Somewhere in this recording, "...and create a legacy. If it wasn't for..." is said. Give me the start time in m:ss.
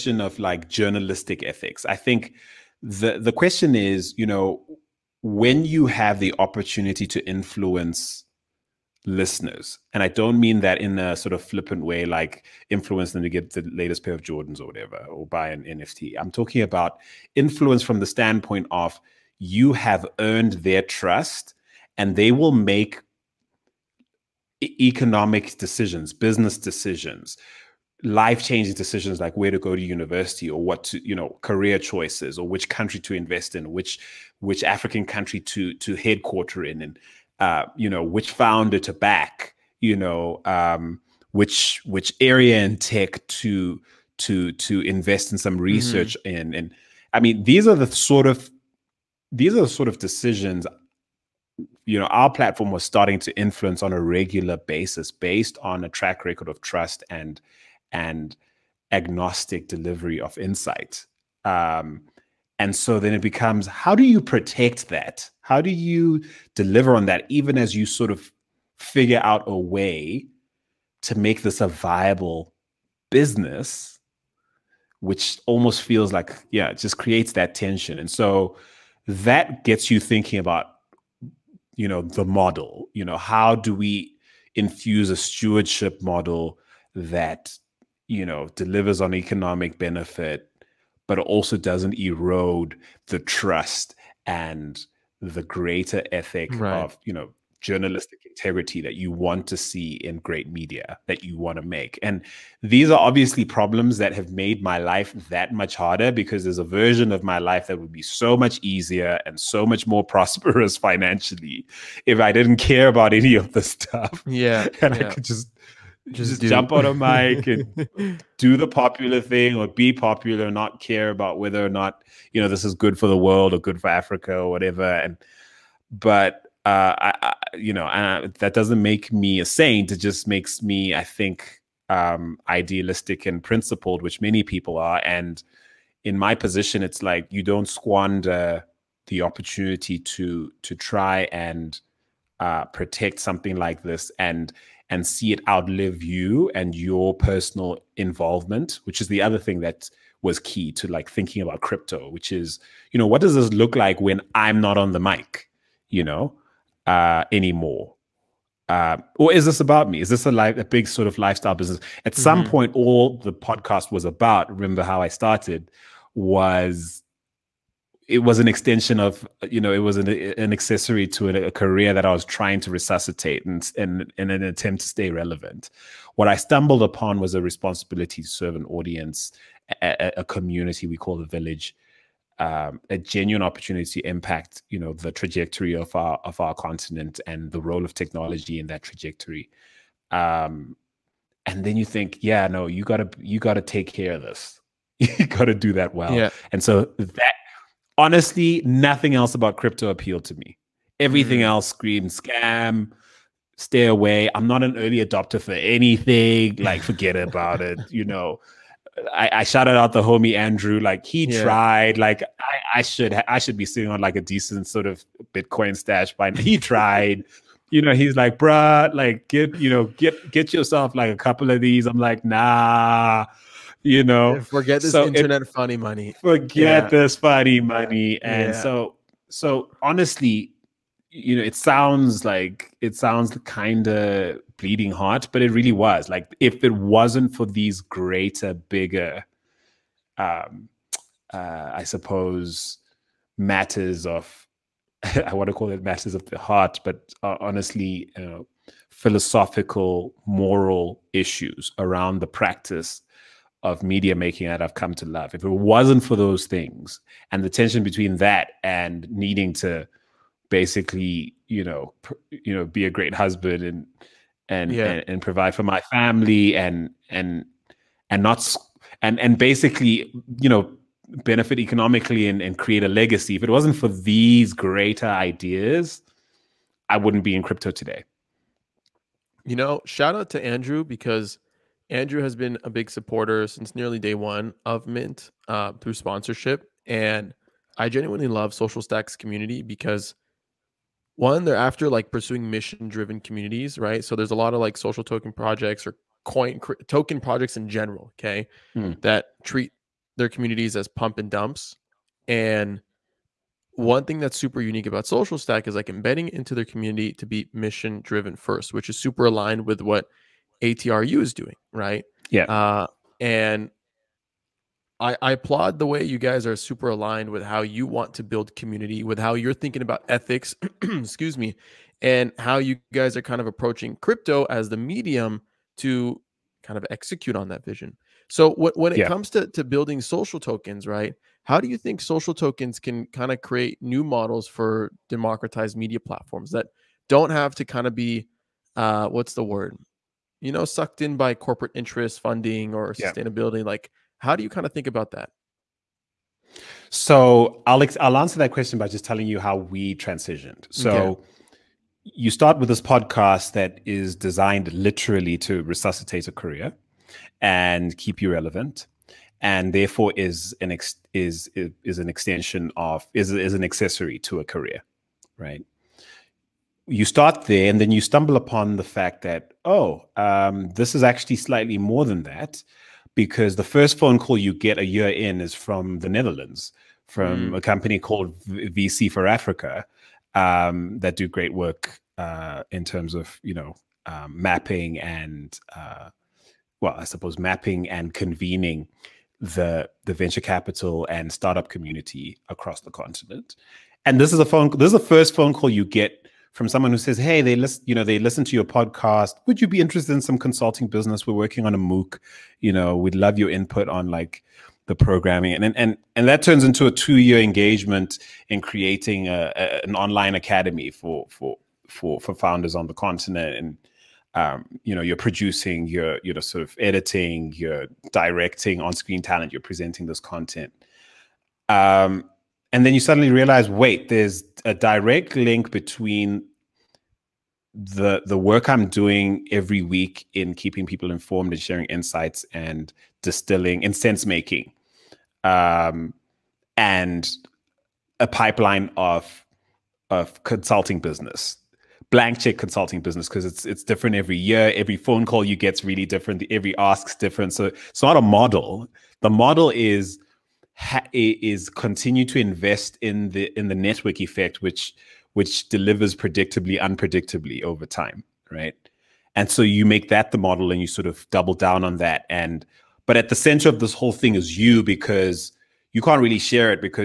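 4:32.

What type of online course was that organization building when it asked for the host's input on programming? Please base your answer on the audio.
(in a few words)
MOOC.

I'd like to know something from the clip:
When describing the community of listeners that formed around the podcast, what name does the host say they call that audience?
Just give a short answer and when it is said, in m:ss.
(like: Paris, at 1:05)
the village, at 3:01.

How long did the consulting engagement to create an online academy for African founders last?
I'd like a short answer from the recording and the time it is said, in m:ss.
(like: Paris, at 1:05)
2 years, at 6:46.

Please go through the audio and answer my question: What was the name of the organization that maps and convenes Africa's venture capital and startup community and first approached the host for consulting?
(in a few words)
VC for Africa.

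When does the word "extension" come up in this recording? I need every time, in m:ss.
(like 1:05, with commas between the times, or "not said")
2:48, 6:02.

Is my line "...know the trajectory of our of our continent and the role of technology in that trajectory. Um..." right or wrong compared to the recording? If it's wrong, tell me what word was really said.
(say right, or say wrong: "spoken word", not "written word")
right.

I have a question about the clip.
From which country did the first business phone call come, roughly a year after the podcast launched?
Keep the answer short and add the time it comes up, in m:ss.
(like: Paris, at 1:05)
the Netherlands, at 6:16.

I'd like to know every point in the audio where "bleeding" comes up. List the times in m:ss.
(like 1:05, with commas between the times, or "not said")
3:54.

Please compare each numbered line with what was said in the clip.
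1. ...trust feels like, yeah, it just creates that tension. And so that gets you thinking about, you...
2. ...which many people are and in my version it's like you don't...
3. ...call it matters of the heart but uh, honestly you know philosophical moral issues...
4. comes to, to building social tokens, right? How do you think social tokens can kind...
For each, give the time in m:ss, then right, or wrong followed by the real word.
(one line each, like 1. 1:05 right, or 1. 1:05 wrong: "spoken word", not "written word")
1. 1:15 wrong: "almost", not "trust"
2. 2:14 wrong: "position", not "version"
3. 4:05 right
4. 5:29 right.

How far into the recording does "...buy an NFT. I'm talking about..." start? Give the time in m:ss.
0:15.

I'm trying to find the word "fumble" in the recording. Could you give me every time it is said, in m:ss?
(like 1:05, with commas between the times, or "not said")
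not said.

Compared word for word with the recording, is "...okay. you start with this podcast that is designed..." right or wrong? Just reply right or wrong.
right.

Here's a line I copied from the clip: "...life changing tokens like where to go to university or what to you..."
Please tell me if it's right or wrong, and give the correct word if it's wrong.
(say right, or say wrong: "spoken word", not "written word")
wrong: "decisions", not "tokens".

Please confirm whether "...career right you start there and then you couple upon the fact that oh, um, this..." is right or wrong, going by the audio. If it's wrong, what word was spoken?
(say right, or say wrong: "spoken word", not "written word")
wrong: "stumble", not "couple".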